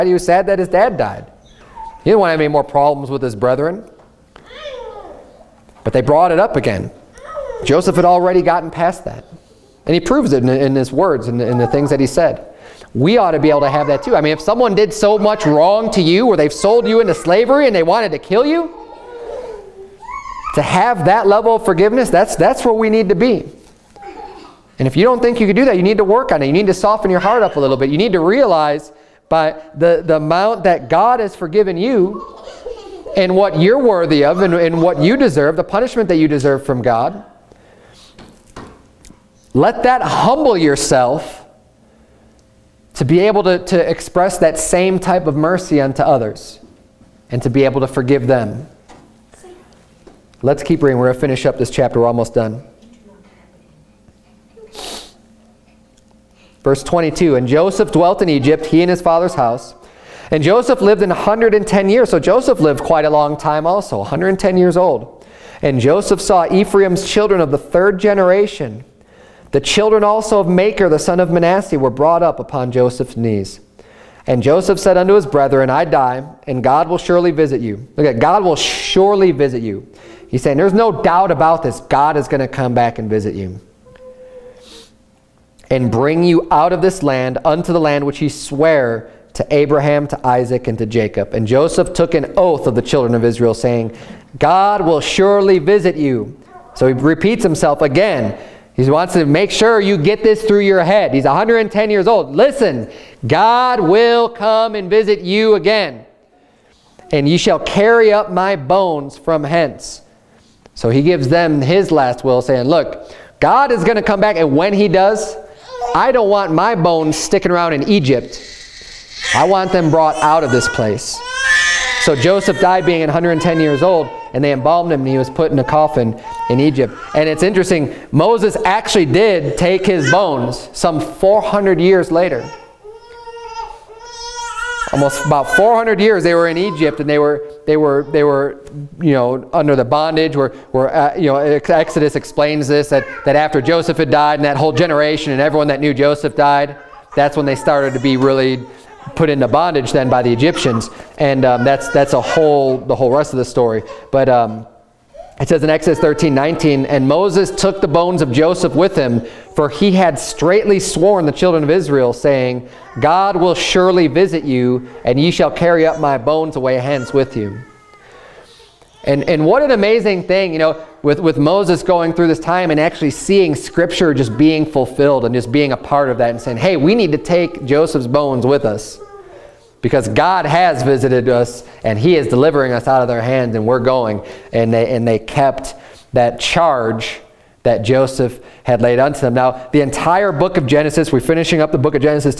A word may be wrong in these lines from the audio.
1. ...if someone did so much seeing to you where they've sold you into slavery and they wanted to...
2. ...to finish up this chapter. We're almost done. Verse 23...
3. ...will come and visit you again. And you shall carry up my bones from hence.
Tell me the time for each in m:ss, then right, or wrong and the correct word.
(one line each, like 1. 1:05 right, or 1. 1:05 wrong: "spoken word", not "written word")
1. 0:14 wrong: "wrong", not "seeing"
2. 0:51 wrong: "22", not "23"
3. 1:43 right.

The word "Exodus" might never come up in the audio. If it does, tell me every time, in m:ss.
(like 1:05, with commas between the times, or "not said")
2:21, 2:35.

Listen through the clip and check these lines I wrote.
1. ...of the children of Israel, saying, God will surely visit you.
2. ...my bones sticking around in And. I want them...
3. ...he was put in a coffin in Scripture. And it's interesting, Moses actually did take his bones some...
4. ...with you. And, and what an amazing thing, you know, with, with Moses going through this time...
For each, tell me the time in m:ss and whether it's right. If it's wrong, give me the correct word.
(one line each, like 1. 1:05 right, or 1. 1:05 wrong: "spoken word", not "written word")
1. 1:32 right
2. 1:56 wrong: "Egypt", not "And"
3. 2:05 wrong: "Egypt", not "Scripture"
4. 2:47 right.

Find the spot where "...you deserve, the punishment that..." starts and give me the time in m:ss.
0:35.